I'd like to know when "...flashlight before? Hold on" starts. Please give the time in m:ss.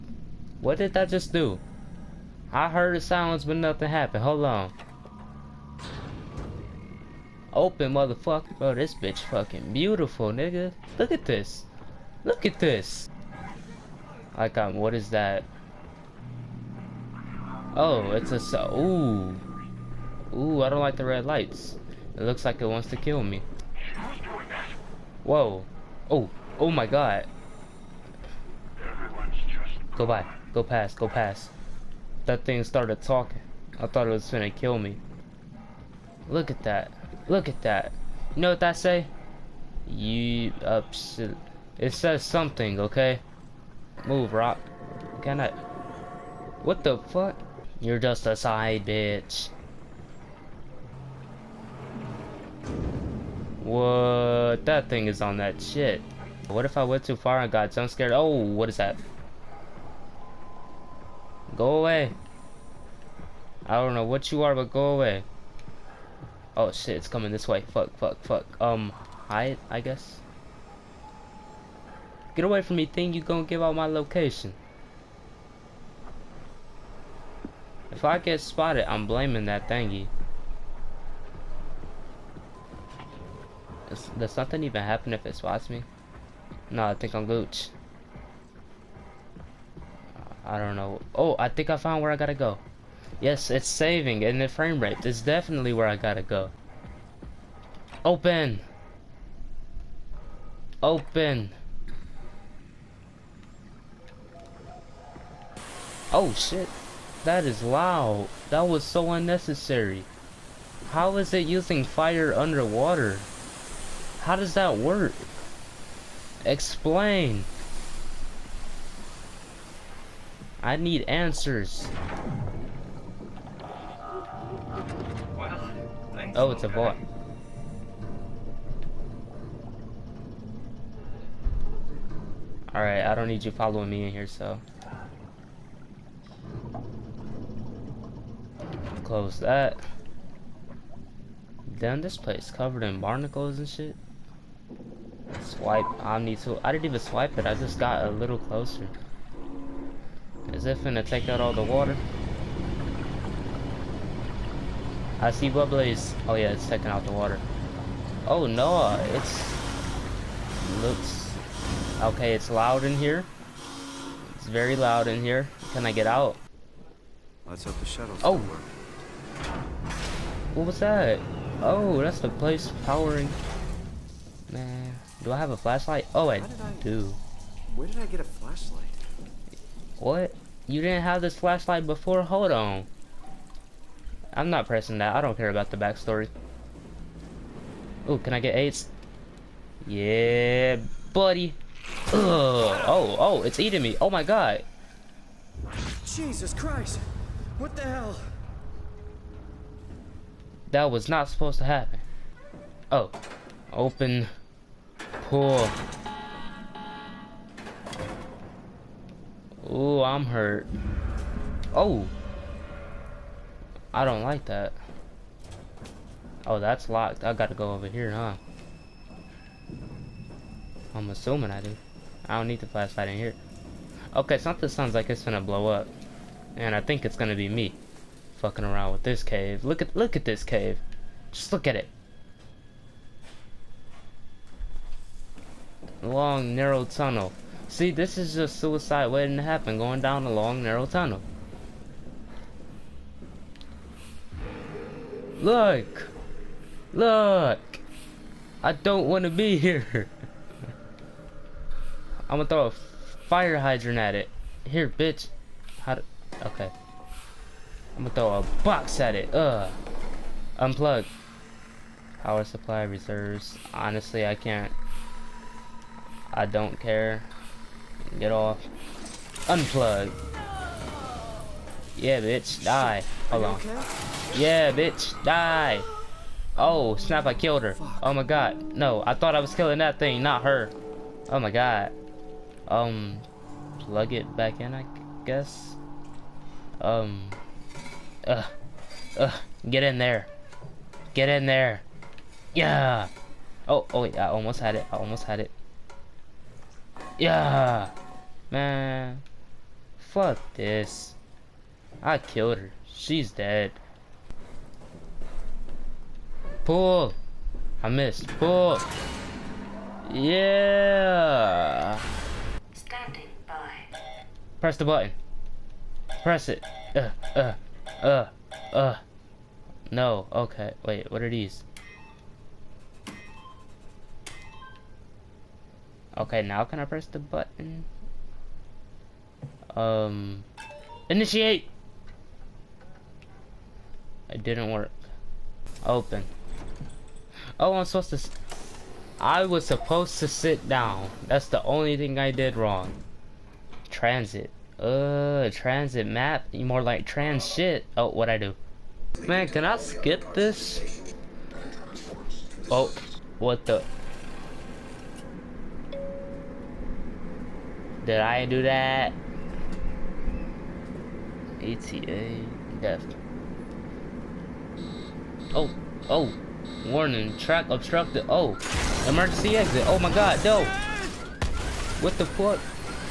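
3:01.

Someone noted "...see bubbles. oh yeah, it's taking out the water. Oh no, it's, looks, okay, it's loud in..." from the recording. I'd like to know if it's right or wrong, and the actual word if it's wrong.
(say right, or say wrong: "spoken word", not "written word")
right.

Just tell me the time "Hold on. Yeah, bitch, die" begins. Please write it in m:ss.
4:33.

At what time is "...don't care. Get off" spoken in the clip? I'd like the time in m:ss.
4:26.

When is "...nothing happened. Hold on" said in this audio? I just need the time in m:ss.
0:03.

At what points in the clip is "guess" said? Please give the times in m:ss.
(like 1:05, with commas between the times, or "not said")
1:09, 4:45.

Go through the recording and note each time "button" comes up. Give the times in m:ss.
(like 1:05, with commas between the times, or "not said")
5:14, 5:27.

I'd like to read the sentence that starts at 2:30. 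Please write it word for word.
Is it finna take out all the water?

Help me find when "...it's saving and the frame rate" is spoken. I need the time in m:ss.
1:33.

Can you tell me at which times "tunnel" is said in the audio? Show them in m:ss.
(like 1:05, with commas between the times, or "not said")
3:56, 4:00.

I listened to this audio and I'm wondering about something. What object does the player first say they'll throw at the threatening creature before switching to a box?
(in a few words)
Fire hydrant.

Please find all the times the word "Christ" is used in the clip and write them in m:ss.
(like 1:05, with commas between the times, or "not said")
3:16.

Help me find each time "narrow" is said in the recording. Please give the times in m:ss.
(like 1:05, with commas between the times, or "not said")
3:56, 4:00.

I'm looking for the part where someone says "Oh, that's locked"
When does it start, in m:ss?
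3:36.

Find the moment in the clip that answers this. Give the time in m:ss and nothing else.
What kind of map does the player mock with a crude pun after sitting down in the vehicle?
5:45.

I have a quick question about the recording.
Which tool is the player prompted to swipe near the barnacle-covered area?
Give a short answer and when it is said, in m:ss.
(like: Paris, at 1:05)
Omni tool, at 2:26.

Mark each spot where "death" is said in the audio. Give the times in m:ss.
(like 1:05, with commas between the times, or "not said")
6:02.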